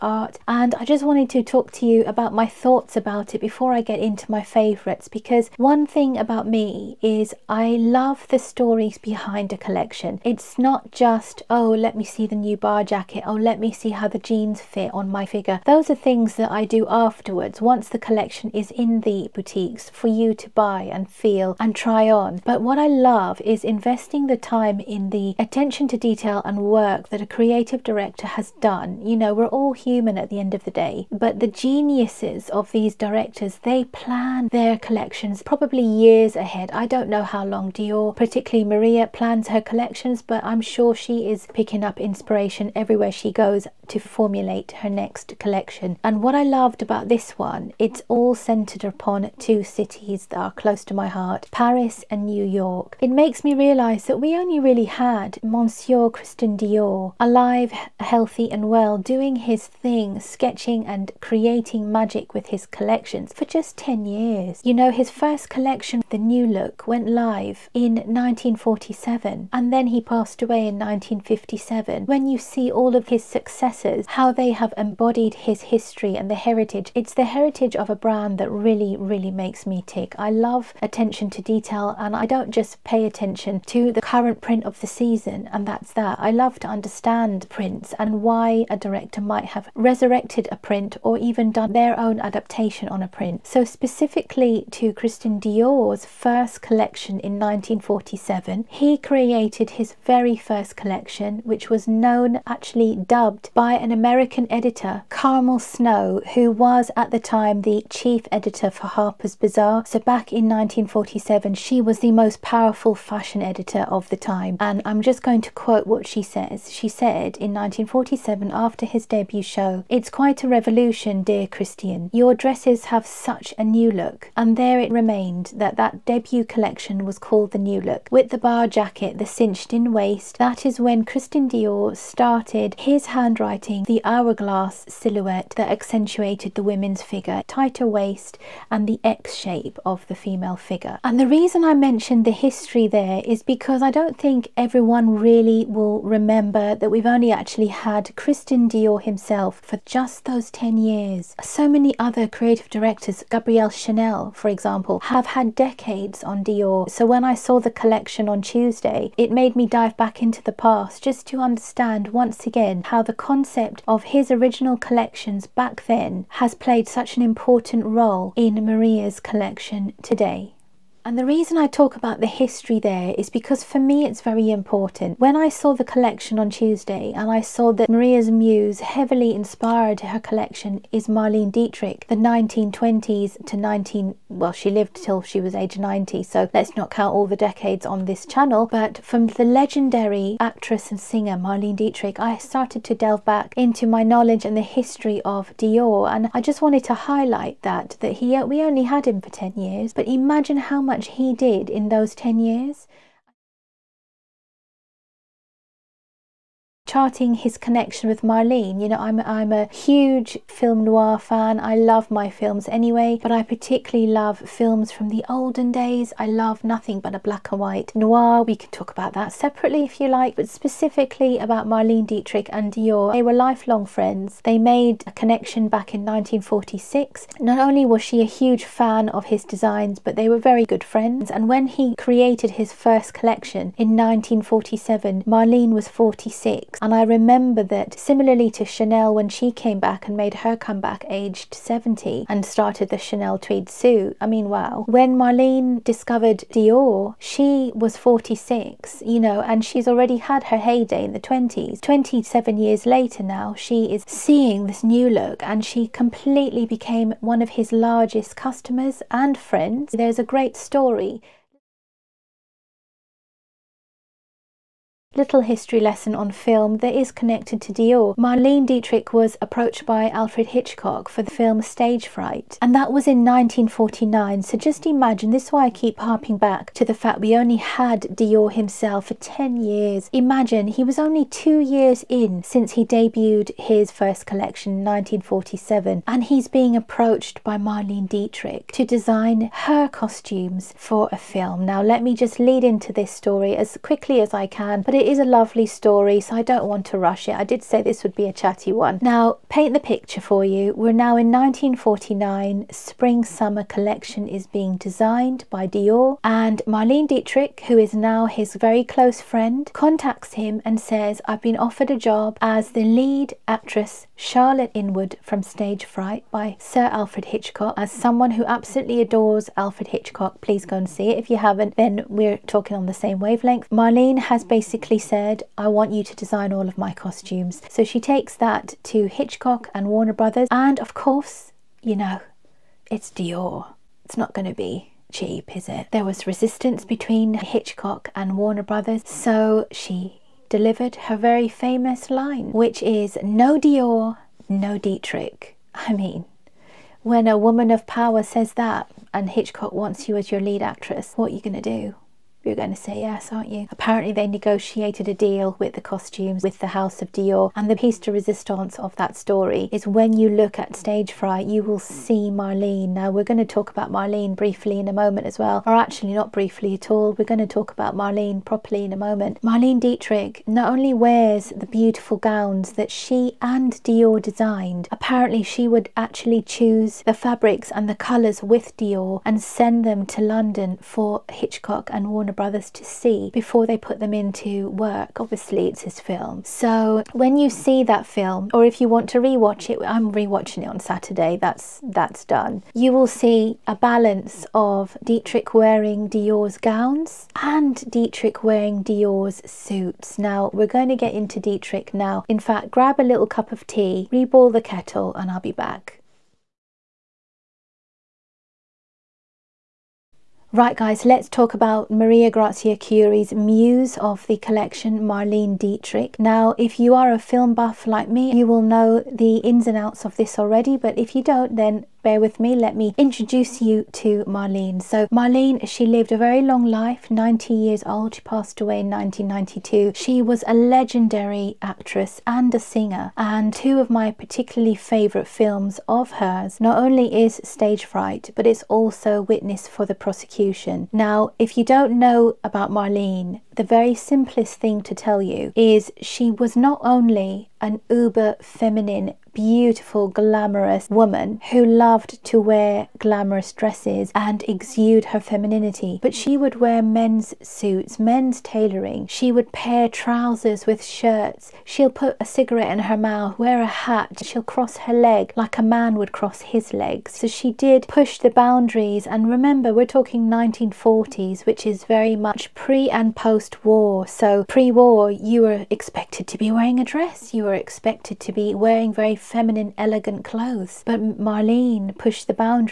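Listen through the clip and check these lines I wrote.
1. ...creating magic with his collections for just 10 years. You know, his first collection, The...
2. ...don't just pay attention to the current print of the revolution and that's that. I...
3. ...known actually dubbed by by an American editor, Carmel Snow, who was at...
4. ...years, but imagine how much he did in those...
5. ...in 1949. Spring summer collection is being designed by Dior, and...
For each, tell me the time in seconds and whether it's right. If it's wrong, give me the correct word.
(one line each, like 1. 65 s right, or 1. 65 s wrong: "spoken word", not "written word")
1. 61 s right
2. 82 s wrong: "season", not "revolution"
3. 101 s right
4. 199 s right
5. 301 s right.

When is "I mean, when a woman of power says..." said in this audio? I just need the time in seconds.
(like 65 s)
345 s.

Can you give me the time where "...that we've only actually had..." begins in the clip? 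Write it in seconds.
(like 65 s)
146 s.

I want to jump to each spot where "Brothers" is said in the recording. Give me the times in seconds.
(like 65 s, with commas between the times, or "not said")
330 s, 338 s, 382 s.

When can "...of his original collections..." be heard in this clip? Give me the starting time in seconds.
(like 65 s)
163 s.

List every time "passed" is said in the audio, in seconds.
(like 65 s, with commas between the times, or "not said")
69 s, 428 s.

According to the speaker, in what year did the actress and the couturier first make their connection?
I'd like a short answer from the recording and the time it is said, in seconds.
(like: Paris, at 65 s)
1946, at 226 s.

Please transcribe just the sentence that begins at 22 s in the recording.
But what I love is investing the time in the attention to detail and work that a creative director has done.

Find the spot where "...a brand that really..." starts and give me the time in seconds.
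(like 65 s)
77 s.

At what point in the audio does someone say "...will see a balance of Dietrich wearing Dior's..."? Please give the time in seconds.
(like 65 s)
392 s.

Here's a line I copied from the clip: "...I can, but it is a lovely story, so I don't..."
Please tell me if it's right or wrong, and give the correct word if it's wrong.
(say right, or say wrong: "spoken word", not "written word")
right.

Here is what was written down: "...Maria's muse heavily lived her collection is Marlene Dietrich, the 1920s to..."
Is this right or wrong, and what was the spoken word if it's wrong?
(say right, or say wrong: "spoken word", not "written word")
wrong: "inspired", not "lived".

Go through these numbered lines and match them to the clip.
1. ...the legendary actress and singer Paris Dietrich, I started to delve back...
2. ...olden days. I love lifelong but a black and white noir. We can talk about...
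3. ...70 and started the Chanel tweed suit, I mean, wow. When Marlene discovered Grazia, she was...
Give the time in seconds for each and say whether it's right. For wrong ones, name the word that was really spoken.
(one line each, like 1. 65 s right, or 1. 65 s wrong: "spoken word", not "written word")
1. 189 s wrong: "Marlene", not "Paris"
2. 215 s wrong: "nothing", not "lifelong"
3. 241 s wrong: "Dior", not "Grazia".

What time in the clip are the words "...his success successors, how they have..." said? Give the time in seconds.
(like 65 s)
73 s.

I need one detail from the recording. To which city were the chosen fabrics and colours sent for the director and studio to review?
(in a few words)
London.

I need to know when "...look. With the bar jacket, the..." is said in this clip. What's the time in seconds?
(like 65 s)
127 s.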